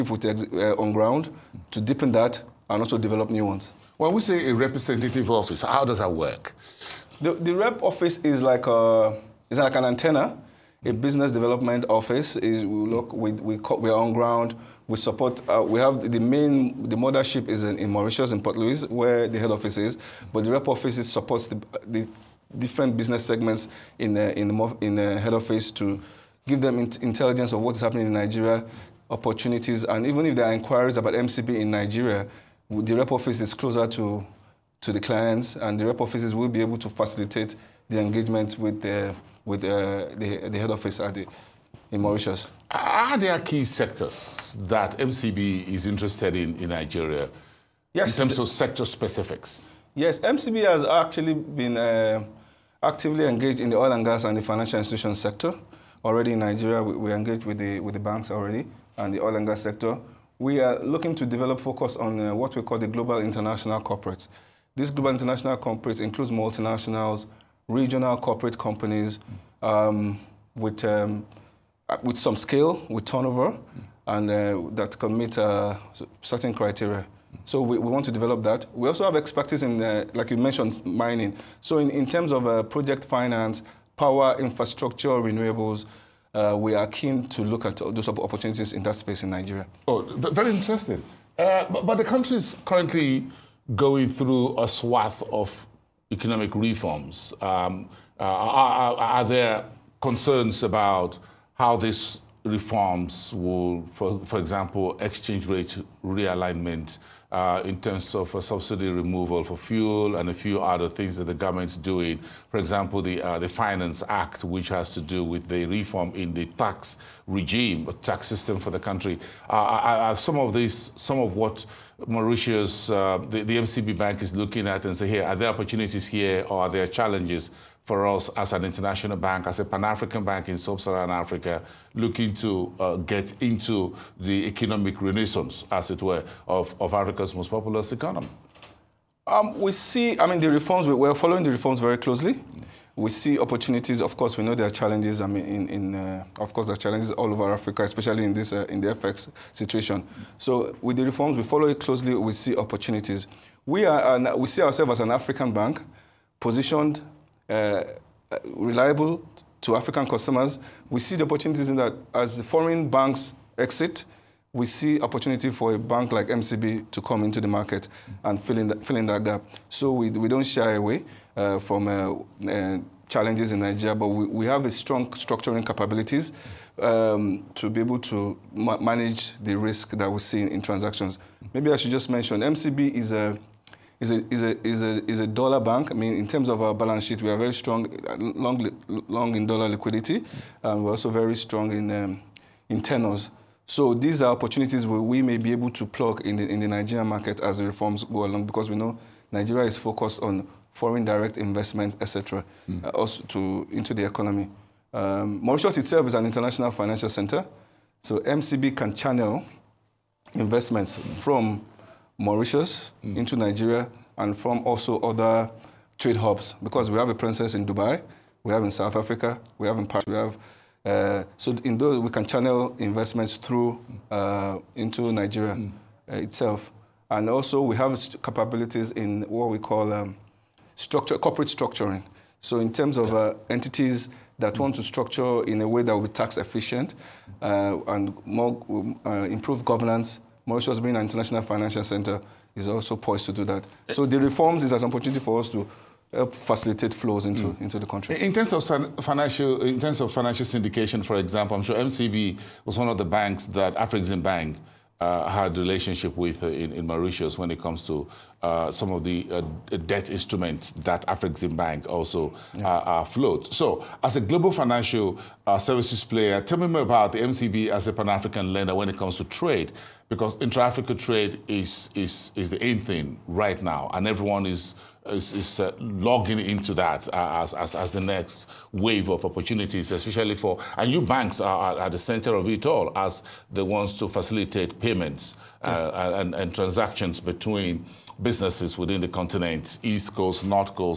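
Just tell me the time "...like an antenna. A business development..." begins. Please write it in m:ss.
0:09.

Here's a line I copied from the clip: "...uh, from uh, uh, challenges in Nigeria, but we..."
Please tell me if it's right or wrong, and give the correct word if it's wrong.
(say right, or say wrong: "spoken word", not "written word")
right.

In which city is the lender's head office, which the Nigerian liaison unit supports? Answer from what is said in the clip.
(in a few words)
Port Louis.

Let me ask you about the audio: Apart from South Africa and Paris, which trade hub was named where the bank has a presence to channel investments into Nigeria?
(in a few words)
Dubai.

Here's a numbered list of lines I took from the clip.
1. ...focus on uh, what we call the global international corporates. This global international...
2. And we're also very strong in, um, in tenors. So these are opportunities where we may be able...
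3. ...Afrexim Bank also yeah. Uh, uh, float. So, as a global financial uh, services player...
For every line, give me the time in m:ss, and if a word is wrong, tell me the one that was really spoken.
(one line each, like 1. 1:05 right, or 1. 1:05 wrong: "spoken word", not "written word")
1. 1:01 right
2. 3:10 right
3. 4:21 right.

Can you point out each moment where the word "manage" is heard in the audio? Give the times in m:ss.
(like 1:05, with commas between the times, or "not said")
2:58.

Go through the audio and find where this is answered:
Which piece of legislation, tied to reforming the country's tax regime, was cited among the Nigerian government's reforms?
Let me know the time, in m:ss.
1:53.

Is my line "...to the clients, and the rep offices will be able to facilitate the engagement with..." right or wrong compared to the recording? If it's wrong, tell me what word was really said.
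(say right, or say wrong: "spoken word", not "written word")
right.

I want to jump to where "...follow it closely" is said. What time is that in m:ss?
2:31.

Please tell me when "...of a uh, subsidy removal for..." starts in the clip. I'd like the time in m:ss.
1:48.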